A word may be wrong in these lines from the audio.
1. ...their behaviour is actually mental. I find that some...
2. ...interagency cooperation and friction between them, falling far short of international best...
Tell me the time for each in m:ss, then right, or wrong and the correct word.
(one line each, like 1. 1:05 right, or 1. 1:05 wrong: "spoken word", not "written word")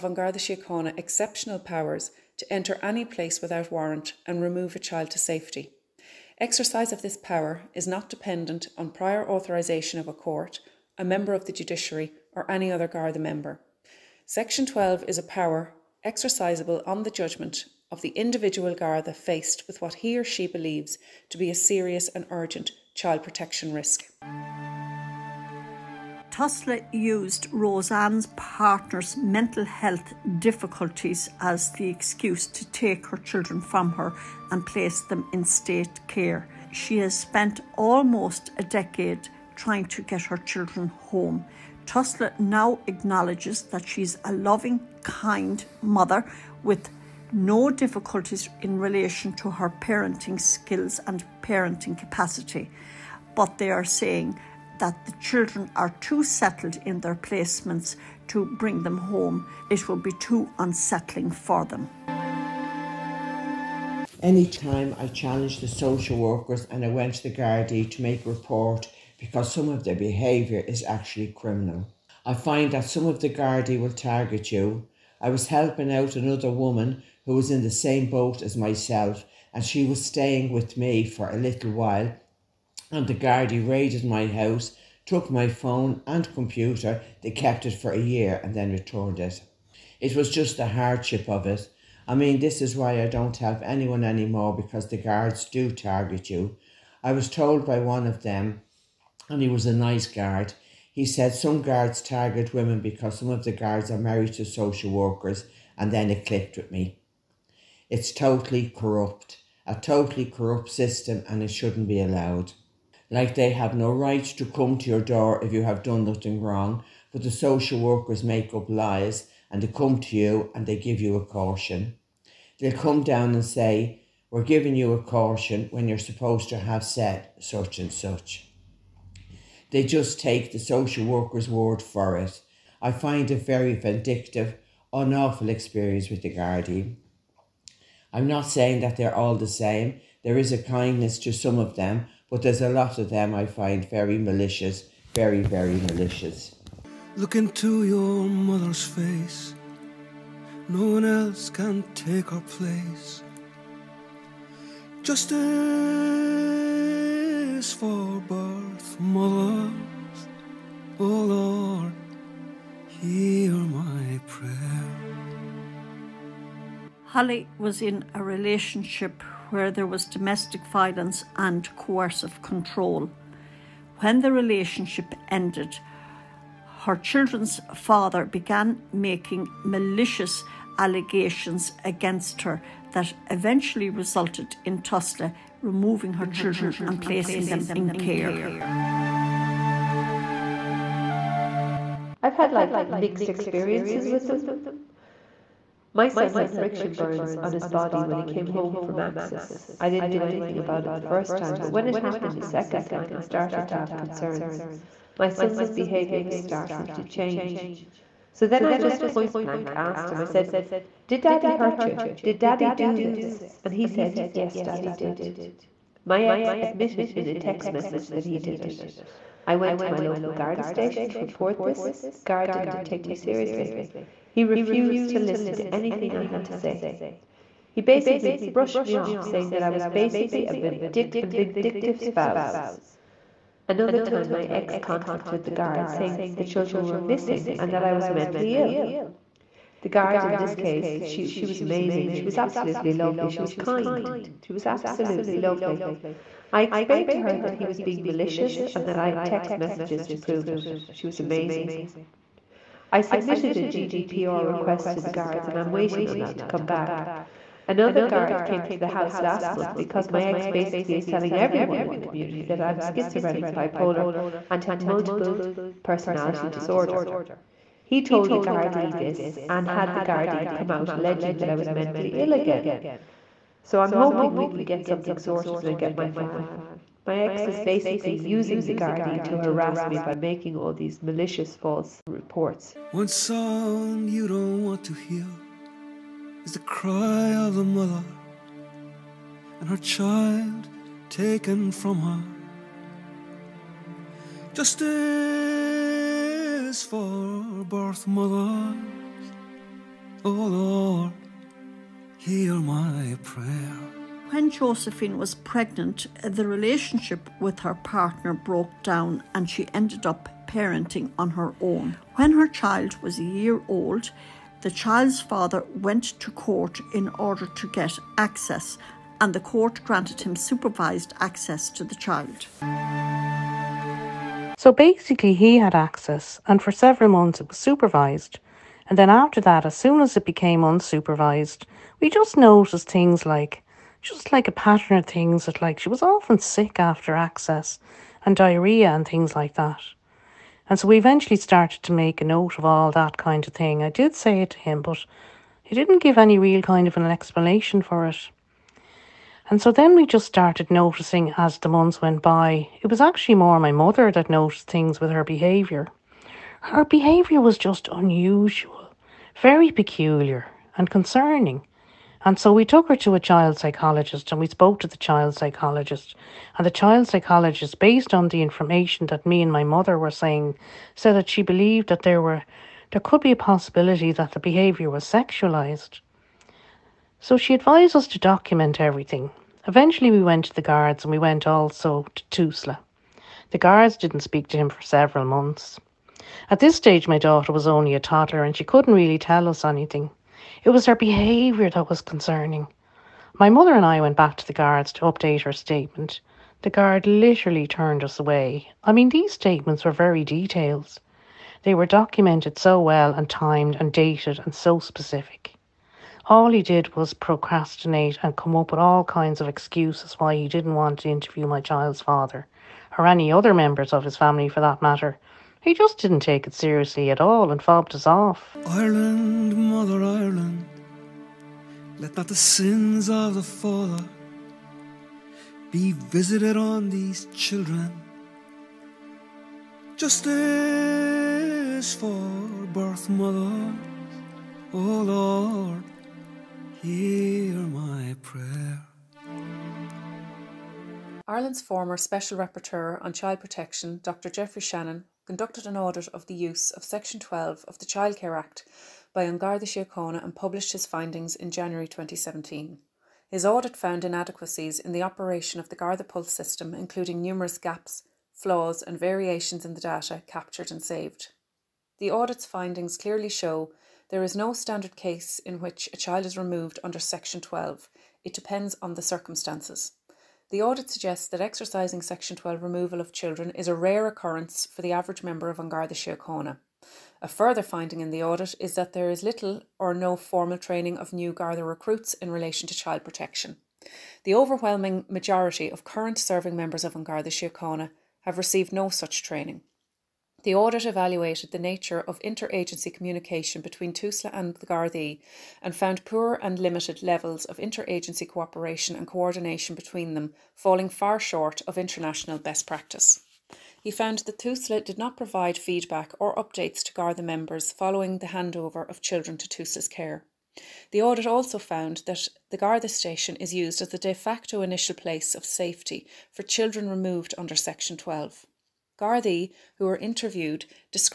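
1. 1:09 wrong: "criminal", not "mental"
2. 8:17 wrong: "coordination", not "friction".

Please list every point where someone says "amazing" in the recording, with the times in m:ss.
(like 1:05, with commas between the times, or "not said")
4:01, 4:11.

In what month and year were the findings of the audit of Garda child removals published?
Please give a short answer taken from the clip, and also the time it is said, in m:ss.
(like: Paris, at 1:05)
January 2017, at 7:31.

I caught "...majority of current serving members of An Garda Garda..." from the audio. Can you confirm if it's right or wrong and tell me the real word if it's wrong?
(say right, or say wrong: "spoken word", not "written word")
wrong: "Síochána", not "Garda".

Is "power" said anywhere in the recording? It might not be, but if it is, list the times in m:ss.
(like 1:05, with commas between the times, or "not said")
0:01, 0:07, 0:15.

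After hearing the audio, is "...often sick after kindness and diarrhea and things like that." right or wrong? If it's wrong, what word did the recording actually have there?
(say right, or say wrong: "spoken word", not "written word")
wrong: "access", not "kindness".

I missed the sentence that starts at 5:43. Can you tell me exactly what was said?
I did say it to him, but he didn't give any real kind of an explanation for it.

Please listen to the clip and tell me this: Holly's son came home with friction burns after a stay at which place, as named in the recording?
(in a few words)
Axis.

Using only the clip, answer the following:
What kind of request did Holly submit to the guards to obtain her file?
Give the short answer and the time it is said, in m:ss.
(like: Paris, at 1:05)
GDPR request, at 4:13.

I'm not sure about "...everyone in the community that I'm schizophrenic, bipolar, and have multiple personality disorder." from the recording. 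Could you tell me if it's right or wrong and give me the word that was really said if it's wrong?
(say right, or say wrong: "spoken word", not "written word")
right.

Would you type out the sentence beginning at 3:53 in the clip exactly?
Another time, my ex contacted the guard saying that the children were missing and that I was mentally ill.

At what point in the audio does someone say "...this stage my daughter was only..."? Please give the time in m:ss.
6:26.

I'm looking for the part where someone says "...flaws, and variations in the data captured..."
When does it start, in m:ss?
7:38.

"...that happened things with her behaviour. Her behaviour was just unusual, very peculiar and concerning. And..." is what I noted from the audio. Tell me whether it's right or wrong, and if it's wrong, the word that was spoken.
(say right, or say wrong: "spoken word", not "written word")
wrong: "noticed", not "happened".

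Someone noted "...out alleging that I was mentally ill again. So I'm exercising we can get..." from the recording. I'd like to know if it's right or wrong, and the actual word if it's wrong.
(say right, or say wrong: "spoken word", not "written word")
wrong: "hoping", not "exercising".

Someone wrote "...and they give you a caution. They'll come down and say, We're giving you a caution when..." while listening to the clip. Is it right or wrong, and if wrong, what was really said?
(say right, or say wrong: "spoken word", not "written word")
right.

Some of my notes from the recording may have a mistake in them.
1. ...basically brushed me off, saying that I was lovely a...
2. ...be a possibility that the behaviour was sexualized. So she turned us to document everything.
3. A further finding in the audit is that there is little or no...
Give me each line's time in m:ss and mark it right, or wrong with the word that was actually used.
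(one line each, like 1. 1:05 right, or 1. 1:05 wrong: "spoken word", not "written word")
1. 3:47 wrong: "basically", not "lovely"
2. 6:13 wrong: "advised", not "turned"
3. 7:57 right.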